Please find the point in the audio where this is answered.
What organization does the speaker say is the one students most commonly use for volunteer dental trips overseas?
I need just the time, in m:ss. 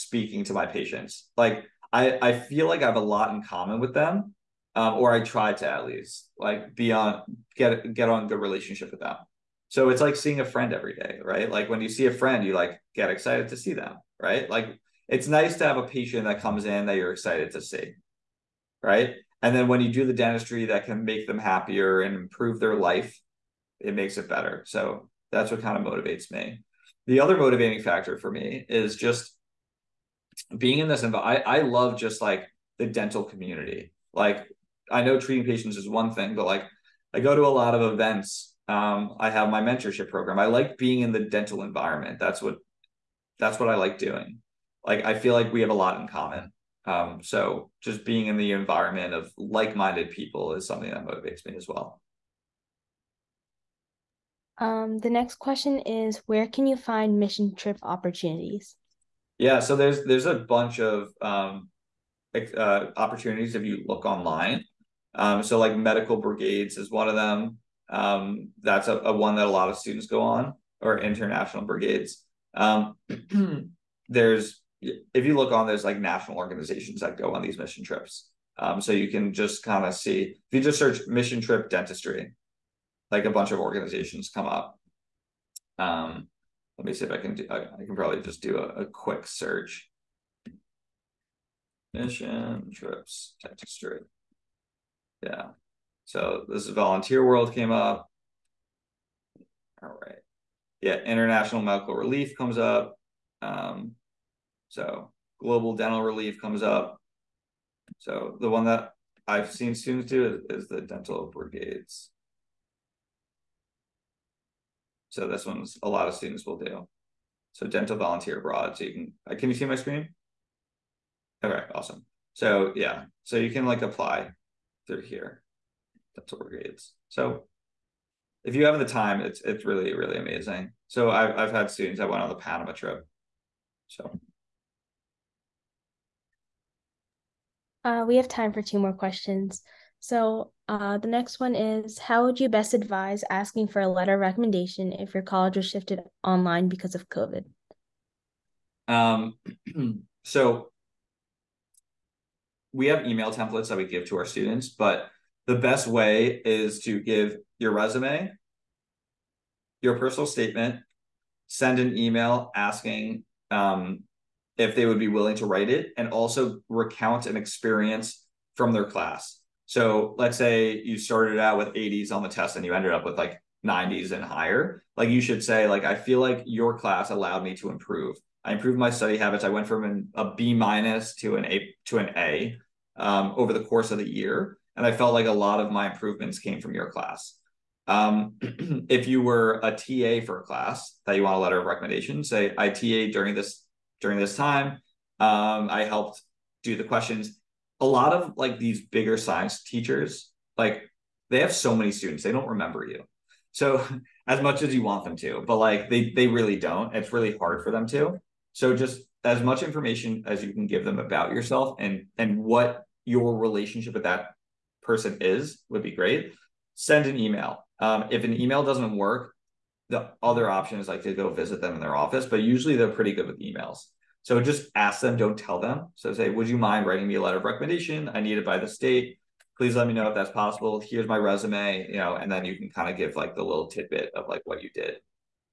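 1:50.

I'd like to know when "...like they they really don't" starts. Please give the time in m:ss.
3:25.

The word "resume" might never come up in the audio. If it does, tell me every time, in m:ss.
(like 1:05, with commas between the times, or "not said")
2:37, 3:51.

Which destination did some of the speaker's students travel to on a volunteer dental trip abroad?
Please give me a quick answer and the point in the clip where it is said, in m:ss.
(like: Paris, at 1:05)
Panama, at 2:12.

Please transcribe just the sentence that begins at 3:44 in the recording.
So just ask them, don't tell them.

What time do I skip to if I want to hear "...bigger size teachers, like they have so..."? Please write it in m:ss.
3:18.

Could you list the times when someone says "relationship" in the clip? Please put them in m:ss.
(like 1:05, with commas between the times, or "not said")
0:08, 3:33.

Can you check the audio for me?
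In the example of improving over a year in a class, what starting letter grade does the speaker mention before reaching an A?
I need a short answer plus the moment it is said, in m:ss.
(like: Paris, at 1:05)
B minus, at 3:00.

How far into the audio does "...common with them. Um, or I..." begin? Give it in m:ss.
0:03.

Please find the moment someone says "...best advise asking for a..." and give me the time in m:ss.
2:22.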